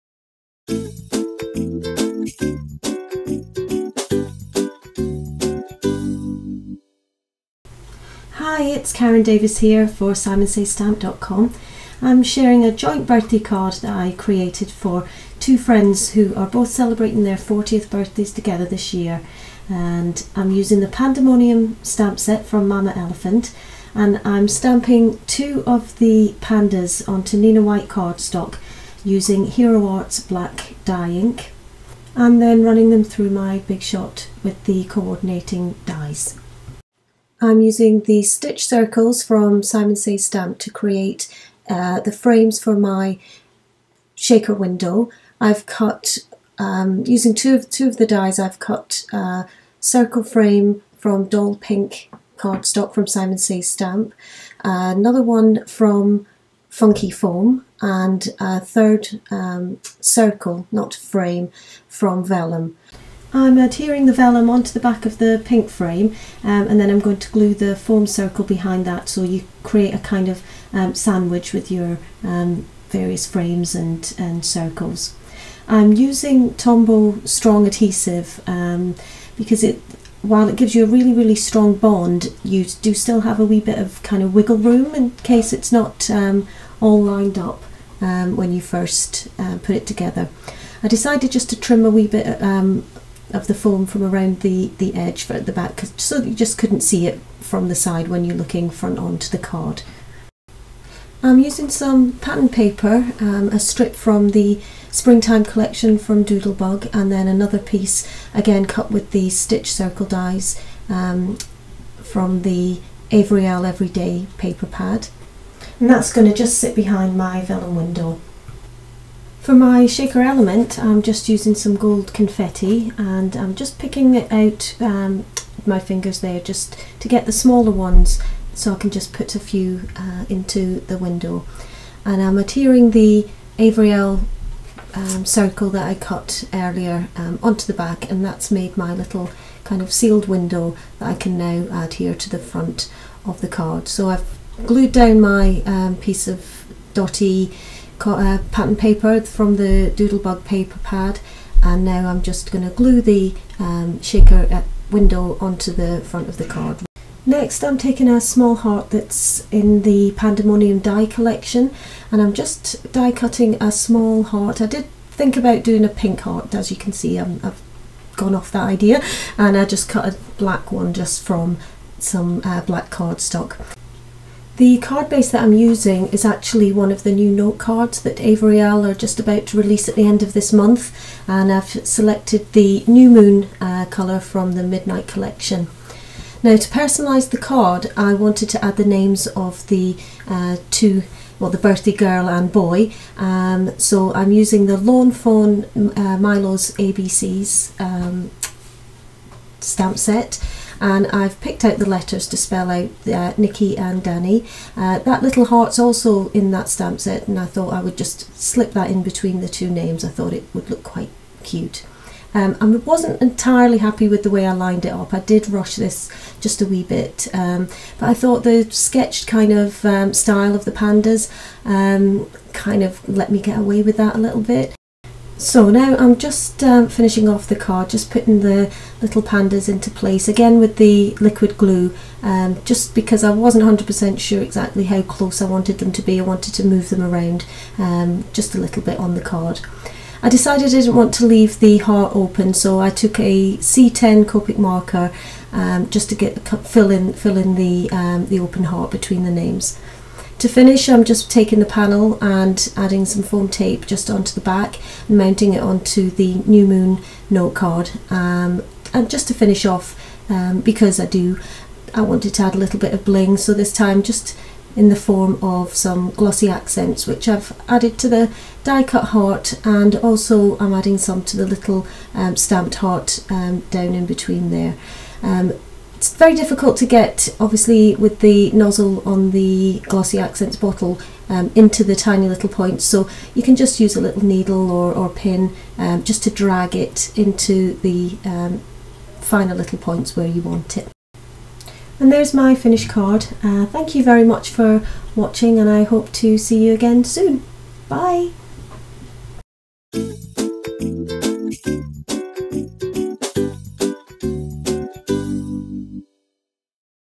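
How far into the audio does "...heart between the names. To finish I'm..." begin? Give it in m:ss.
4:08.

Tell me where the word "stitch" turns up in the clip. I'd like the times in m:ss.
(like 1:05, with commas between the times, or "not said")
0:38, 1:49.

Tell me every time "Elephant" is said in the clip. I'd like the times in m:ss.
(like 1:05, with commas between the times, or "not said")
0:22.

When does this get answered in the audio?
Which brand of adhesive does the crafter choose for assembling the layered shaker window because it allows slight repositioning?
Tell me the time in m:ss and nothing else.
1:16.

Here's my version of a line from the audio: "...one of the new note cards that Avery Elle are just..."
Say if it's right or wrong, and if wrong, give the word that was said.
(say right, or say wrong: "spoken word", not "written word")
right.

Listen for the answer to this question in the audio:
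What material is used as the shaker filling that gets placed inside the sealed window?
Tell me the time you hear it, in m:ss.
2:01.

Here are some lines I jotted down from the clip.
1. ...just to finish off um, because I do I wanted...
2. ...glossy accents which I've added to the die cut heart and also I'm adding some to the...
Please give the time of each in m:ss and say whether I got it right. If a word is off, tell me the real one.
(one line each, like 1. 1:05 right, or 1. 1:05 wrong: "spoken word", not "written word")
1. 4:19 right
2. 4:26 right.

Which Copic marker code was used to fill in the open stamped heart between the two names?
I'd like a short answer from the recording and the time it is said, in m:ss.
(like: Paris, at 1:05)
C10, at 4:03.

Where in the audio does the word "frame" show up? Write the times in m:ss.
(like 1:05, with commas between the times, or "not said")
0:42, 0:50, 1:00, 1:05, 1:13.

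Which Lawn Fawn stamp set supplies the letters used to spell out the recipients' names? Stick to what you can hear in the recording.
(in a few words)
Milo's ABCs.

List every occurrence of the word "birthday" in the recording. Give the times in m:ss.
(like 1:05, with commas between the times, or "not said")
0:13, 0:17, 3:11.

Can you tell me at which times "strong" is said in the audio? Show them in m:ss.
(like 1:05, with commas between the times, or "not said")
1:17, 1:21.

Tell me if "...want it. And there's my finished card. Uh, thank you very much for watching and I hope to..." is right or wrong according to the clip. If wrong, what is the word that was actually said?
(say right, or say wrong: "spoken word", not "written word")
right.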